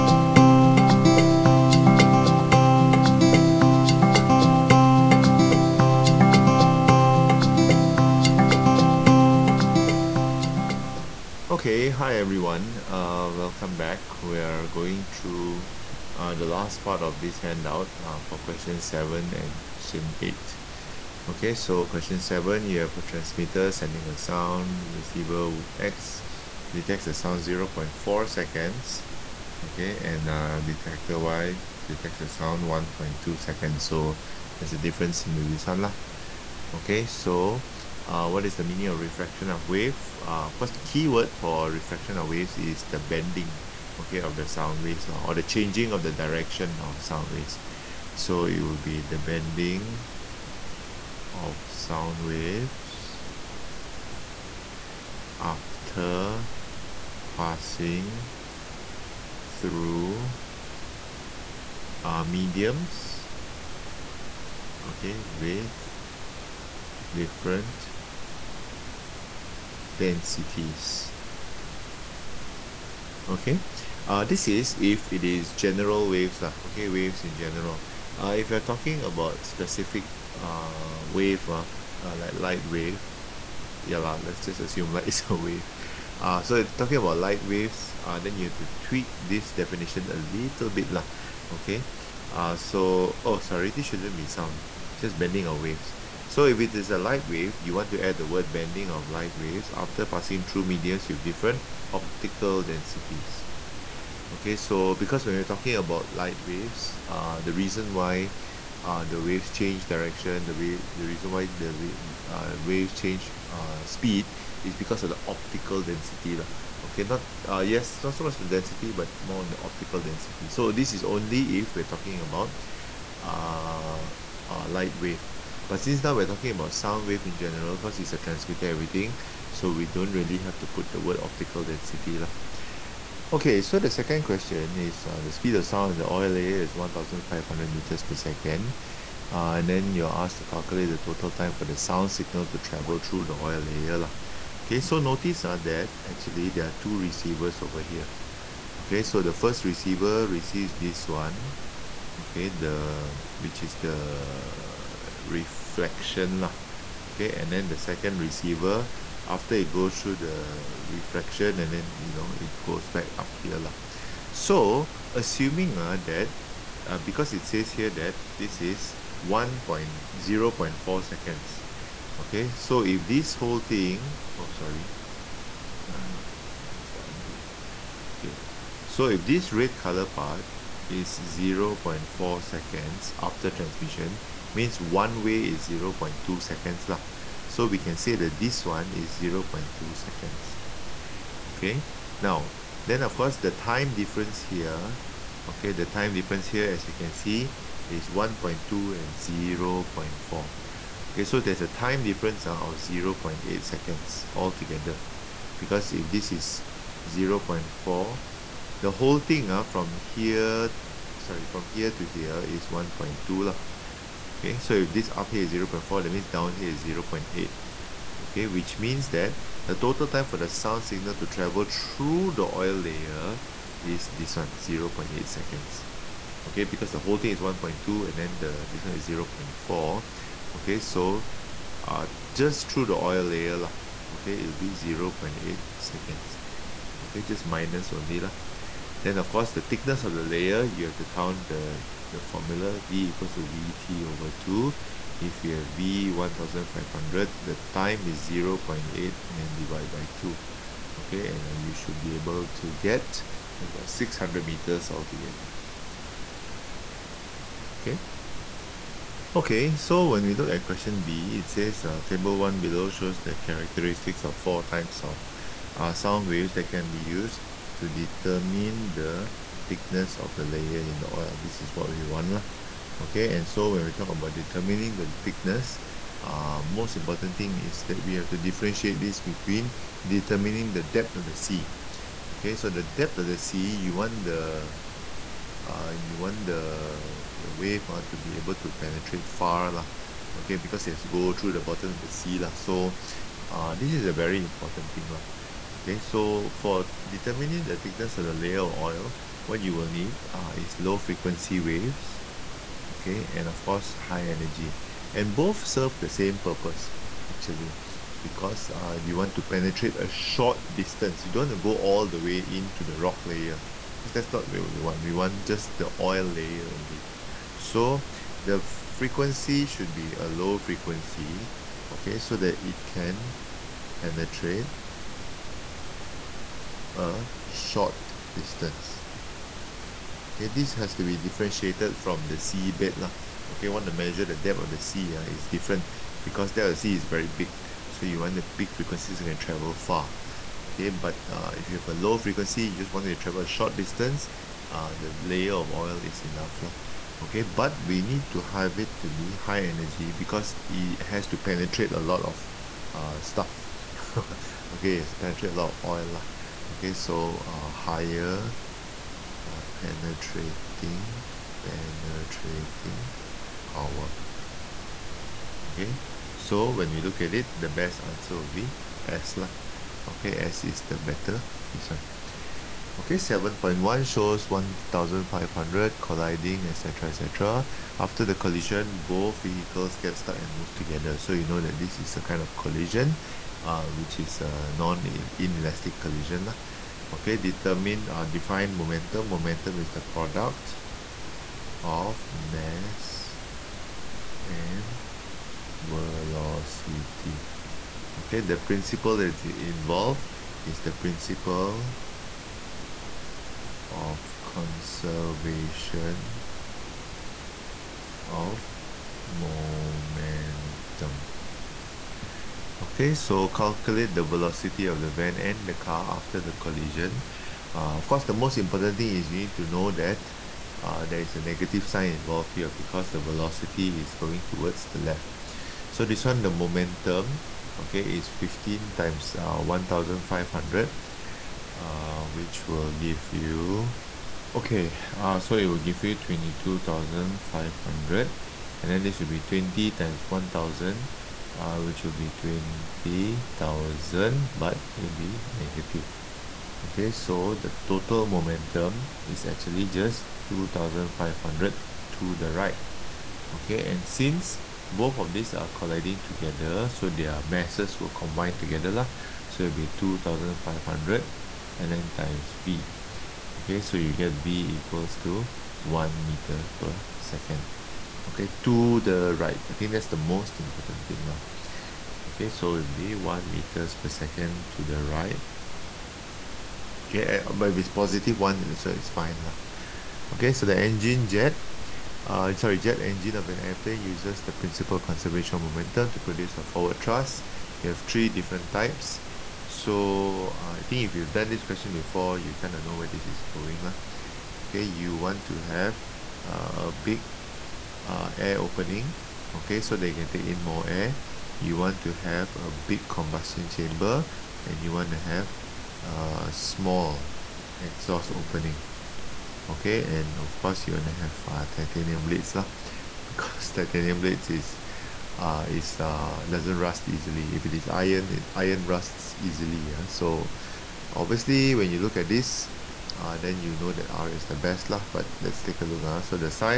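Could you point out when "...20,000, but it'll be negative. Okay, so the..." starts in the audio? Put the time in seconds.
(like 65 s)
442 s.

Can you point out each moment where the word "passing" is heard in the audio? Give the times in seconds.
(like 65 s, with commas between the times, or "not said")
57 s, 100 s.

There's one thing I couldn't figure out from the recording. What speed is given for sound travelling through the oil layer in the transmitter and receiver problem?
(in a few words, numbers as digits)
1,500 meters per second.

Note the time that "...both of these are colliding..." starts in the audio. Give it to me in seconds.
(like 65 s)
454 s.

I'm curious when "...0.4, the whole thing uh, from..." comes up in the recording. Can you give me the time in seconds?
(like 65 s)
207 s.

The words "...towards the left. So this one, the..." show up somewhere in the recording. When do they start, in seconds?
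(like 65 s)
424 s.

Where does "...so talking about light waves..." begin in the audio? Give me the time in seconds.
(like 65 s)
86 s.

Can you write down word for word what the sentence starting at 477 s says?
Okay, uh, but if it's positive one, uh, so it's fine.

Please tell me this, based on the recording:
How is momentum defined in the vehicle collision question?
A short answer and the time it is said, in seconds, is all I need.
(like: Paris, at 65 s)
product of mass and velocity, at 390 s.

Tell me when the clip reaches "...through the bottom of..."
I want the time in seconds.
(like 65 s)
291 s.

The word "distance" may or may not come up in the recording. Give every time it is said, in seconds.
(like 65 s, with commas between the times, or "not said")
310 s, 328 s, 343 s.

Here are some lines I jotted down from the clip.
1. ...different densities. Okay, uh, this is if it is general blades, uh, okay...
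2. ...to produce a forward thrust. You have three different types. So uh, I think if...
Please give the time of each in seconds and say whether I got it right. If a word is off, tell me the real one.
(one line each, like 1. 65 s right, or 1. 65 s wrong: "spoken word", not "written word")
1. 67 s wrong: "waves", not "blades"
2. 486 s right.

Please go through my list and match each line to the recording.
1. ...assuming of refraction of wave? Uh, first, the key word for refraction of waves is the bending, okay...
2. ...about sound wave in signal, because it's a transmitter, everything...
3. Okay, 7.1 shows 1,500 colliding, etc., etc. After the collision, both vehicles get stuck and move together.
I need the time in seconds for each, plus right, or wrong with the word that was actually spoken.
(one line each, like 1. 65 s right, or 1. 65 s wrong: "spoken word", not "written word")
1. 38 s wrong: "meaning", not "assuming"
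2. 126 s wrong: "general", not "signal"
3. 372 s right.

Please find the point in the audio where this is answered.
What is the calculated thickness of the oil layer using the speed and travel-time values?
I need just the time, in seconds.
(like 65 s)
253 s.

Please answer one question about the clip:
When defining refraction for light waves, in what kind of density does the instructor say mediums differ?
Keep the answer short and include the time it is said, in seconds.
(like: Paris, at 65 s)
optical densities, at 101 s.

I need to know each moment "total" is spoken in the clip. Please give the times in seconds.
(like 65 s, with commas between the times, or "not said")
140 s, 219 s, 447 s.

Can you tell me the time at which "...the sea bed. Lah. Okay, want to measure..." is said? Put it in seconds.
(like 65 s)
332 s.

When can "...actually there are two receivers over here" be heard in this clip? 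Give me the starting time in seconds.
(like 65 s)
146 s.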